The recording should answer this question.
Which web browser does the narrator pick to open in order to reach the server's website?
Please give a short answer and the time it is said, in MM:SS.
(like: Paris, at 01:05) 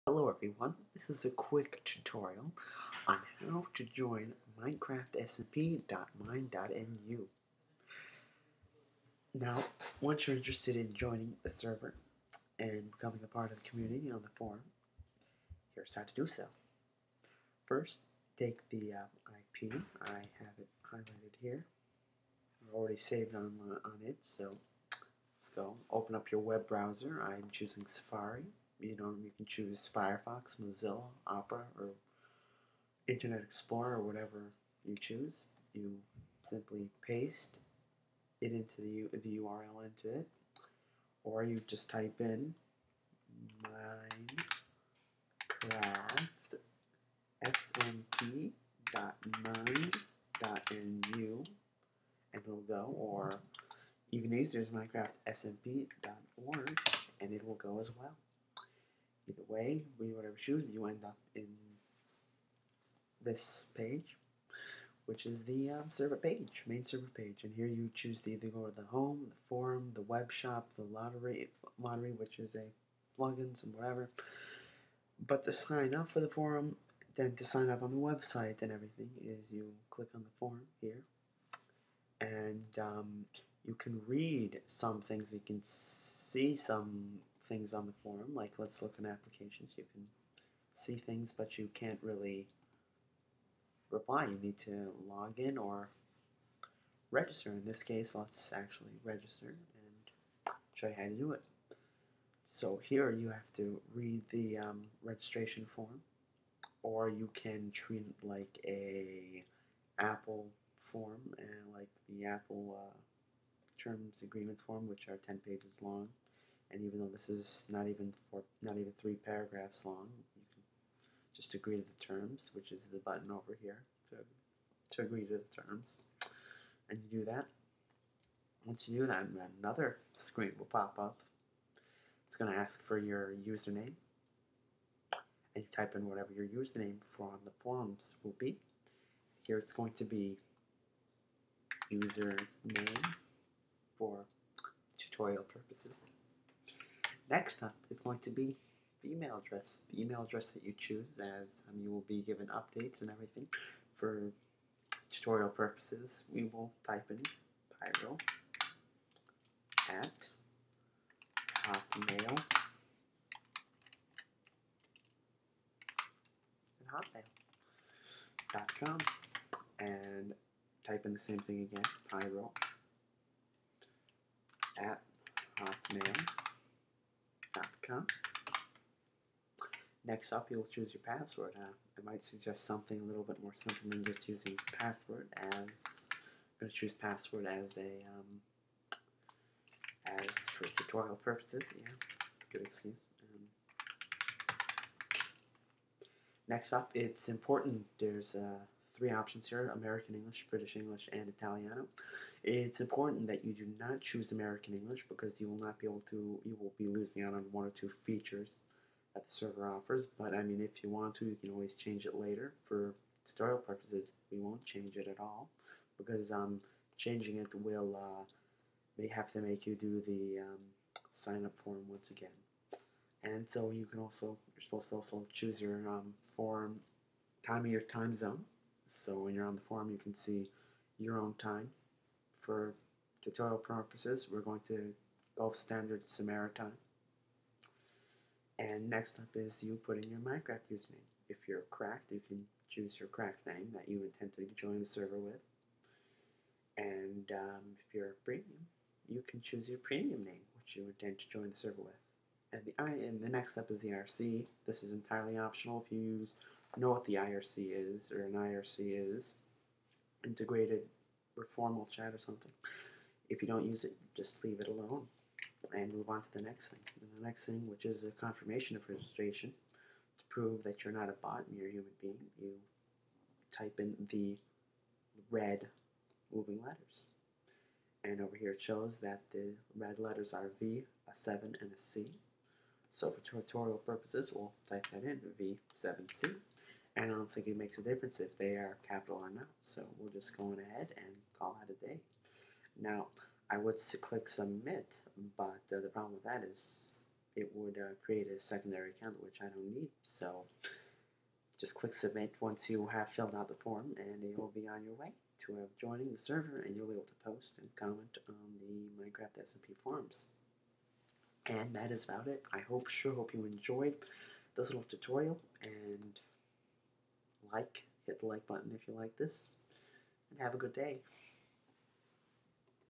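Safari, at 00:27.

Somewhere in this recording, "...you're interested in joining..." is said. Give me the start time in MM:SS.
00:10.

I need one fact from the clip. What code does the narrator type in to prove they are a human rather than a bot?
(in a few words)
V7C.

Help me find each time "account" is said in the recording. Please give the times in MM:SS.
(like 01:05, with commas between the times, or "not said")
04:58.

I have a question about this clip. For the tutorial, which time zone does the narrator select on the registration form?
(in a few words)
Gulf Standard Samara time.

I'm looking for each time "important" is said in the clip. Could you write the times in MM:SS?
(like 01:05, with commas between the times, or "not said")
03:17, 03:22.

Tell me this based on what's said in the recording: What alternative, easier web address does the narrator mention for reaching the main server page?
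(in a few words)
minecraftsmp.org.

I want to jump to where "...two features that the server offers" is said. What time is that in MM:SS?
03:27.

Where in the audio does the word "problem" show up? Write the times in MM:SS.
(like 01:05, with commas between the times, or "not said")
04:55.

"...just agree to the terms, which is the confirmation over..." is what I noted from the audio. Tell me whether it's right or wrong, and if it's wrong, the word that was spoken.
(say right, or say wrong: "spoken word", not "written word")
wrong: "button", not "confirmation".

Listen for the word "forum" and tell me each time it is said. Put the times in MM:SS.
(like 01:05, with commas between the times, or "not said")
00:14, 01:09, 01:16, 01:28, 02:17, 03:49, 05:09.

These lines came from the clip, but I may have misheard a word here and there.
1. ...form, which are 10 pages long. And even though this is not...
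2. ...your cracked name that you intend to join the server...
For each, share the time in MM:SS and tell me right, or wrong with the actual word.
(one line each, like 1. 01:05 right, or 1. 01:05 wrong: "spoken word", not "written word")
1. 01:54 right
2. 04:02 right.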